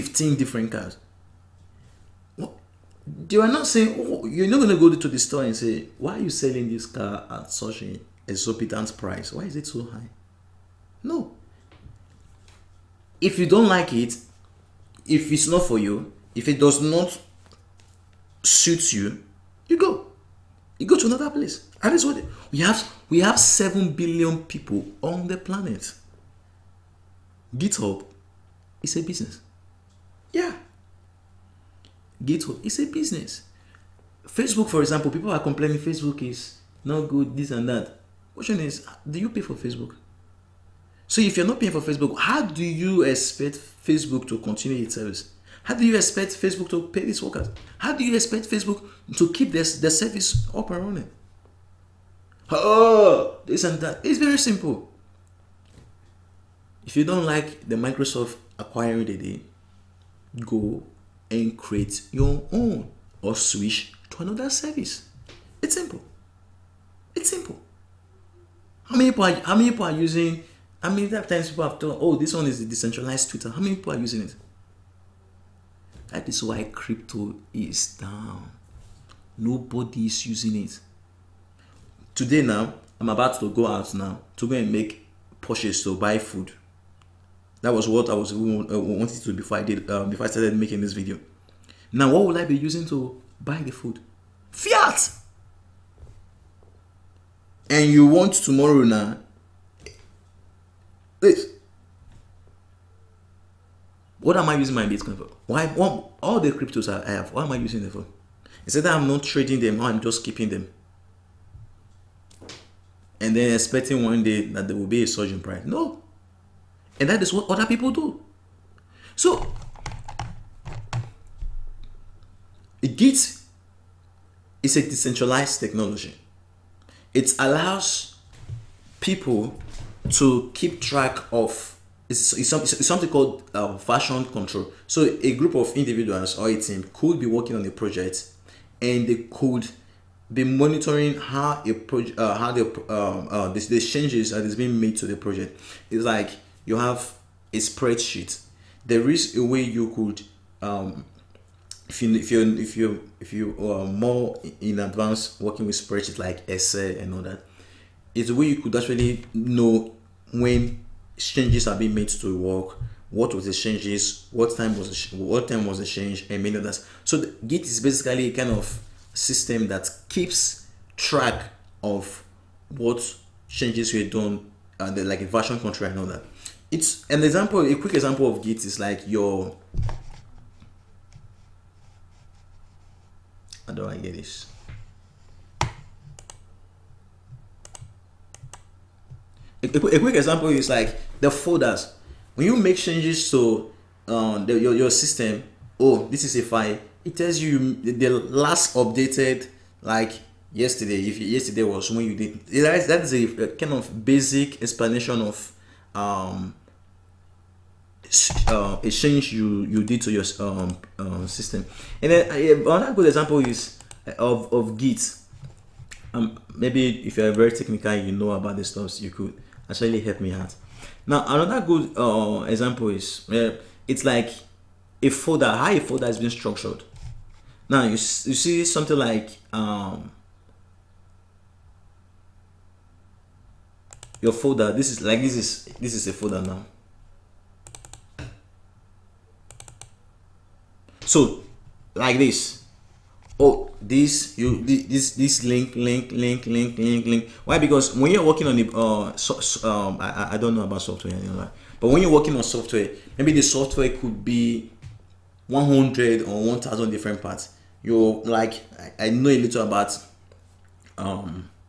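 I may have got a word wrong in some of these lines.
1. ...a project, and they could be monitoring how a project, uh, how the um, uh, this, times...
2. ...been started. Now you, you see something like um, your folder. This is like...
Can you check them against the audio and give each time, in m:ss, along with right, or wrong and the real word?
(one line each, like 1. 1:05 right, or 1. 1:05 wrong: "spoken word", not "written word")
1. 2:17 wrong: "changes", not "times"
2. 3:46 wrong: "structured", not "started".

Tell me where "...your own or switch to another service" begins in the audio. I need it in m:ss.
1:02.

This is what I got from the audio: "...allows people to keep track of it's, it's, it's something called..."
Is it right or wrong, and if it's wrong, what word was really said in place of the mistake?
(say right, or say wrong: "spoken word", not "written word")
right.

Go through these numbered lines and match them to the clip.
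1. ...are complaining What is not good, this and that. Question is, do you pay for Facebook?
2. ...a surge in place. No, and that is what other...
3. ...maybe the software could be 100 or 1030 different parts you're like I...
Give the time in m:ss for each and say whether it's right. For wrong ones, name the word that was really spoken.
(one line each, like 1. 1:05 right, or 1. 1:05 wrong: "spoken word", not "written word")
1. 0:35 wrong: "Facebook", not "What"
2. 1:55 wrong: "price", not "place"
3. 4:13 wrong: "1000", not "1030".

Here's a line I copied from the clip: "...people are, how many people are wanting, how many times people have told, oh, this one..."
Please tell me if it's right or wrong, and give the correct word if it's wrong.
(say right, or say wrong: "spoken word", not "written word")
wrong: "using", not "wanting".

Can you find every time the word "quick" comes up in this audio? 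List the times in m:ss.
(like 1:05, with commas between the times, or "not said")
2:57, 3:09.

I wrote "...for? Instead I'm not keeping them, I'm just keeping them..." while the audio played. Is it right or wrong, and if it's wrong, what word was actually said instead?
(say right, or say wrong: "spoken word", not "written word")
wrong: "trading", not "keeping".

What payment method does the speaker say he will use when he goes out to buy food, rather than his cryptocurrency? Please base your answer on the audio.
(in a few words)
Fiat.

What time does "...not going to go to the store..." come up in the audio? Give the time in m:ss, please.
0:04.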